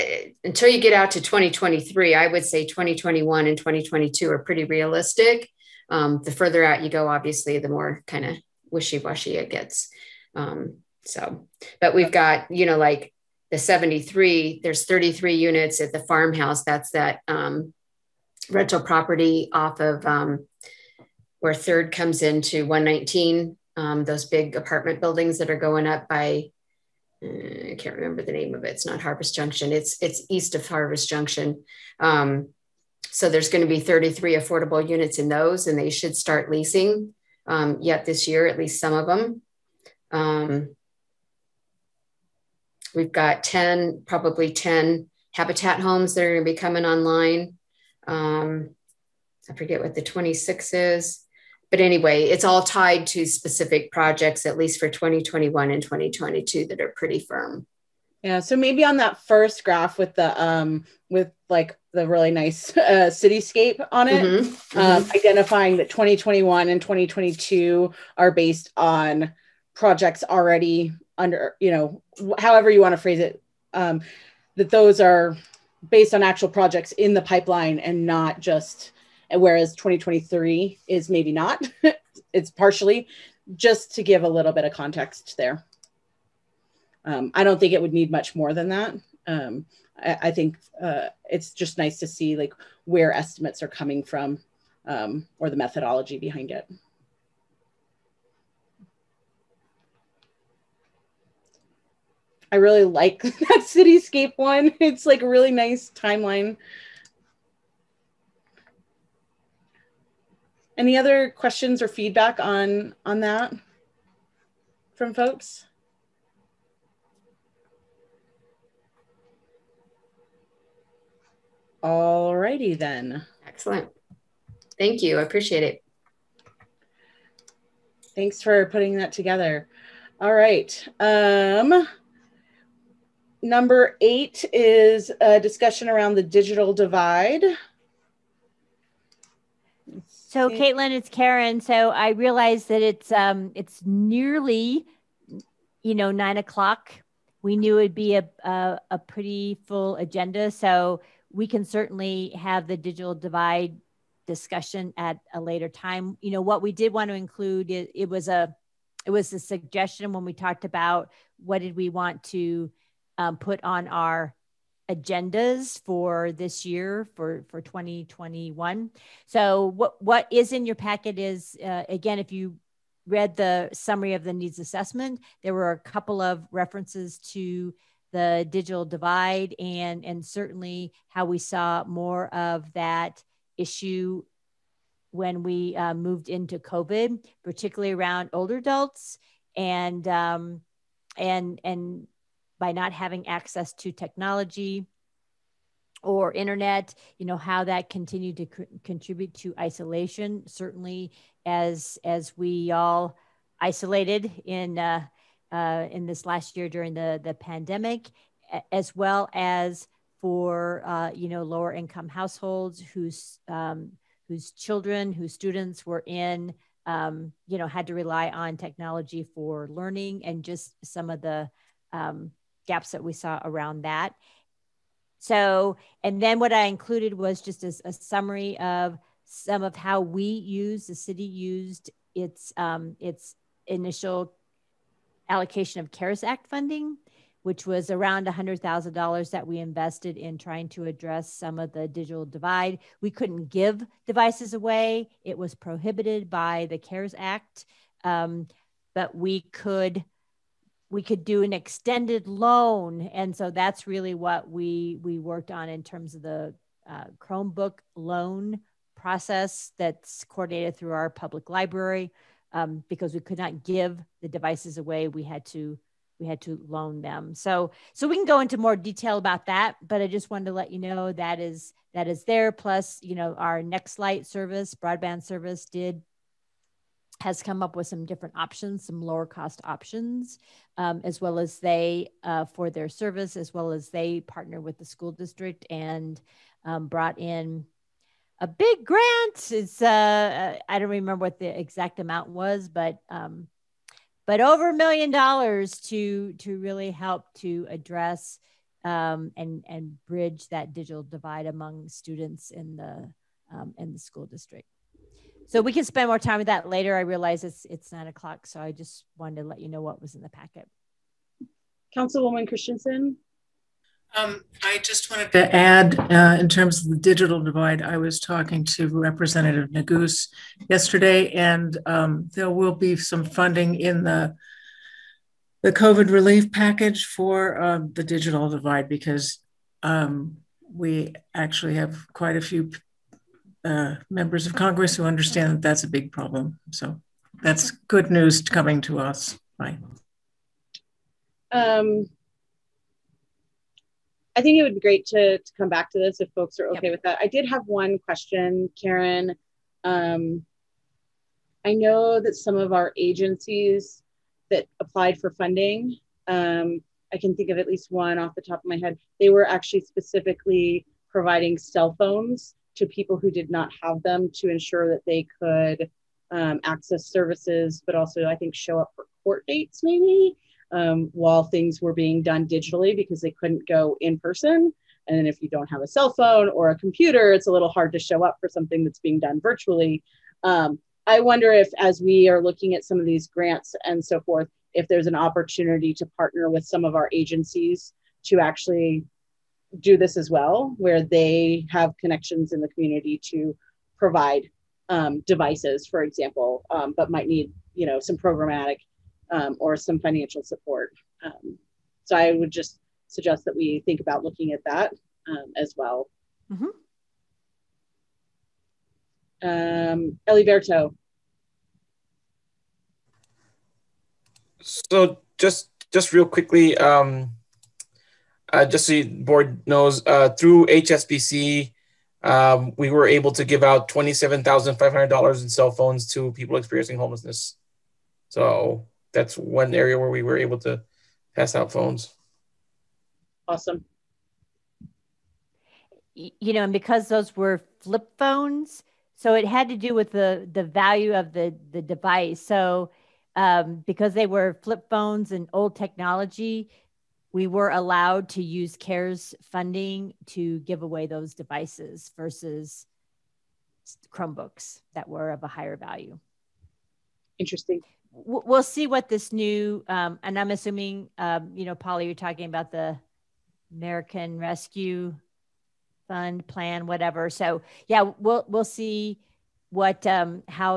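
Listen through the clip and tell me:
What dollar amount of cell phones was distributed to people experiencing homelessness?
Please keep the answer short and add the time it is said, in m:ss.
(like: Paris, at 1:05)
$27,500, at 7:03.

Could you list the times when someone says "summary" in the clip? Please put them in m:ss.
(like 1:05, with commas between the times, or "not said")
2:53, 3:47.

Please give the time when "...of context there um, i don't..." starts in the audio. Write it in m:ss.
1:24.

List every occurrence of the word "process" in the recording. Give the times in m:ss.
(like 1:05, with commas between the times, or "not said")
4:18.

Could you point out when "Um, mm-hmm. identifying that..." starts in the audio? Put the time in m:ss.
1:04.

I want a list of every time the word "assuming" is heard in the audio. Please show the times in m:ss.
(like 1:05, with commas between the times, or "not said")
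7:40.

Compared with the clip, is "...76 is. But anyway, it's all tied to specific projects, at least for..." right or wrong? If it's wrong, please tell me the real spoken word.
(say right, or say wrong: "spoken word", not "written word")
wrong: "26", not "76".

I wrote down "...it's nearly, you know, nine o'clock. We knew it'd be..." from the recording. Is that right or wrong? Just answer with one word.
right.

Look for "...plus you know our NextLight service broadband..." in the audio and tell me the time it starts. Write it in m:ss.
4:32.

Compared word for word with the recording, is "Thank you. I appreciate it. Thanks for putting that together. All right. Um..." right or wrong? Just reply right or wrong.
right.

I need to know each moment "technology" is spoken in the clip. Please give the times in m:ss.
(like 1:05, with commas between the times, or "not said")
3:13, 3:38, 7:25.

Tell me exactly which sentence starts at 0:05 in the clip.
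Um, the further out you go, obviously, the more kind of wishy washy it gets.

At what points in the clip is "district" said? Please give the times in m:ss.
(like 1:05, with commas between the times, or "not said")
4:45, 5:04.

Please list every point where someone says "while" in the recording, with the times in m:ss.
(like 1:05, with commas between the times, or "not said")
6:11.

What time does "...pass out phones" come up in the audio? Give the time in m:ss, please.
7:11.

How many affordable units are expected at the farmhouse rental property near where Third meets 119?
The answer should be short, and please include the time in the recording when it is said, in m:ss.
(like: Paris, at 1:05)
33, at 0:33.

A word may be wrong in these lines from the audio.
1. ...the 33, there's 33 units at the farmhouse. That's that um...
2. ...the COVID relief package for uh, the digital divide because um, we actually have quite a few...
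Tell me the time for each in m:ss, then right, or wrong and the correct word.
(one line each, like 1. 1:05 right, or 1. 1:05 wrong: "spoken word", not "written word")
1. 0:13 wrong: "73", not "33"
2. 5:25 right.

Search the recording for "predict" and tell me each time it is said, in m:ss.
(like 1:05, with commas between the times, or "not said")
not said.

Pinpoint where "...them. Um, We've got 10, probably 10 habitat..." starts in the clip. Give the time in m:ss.
0:39.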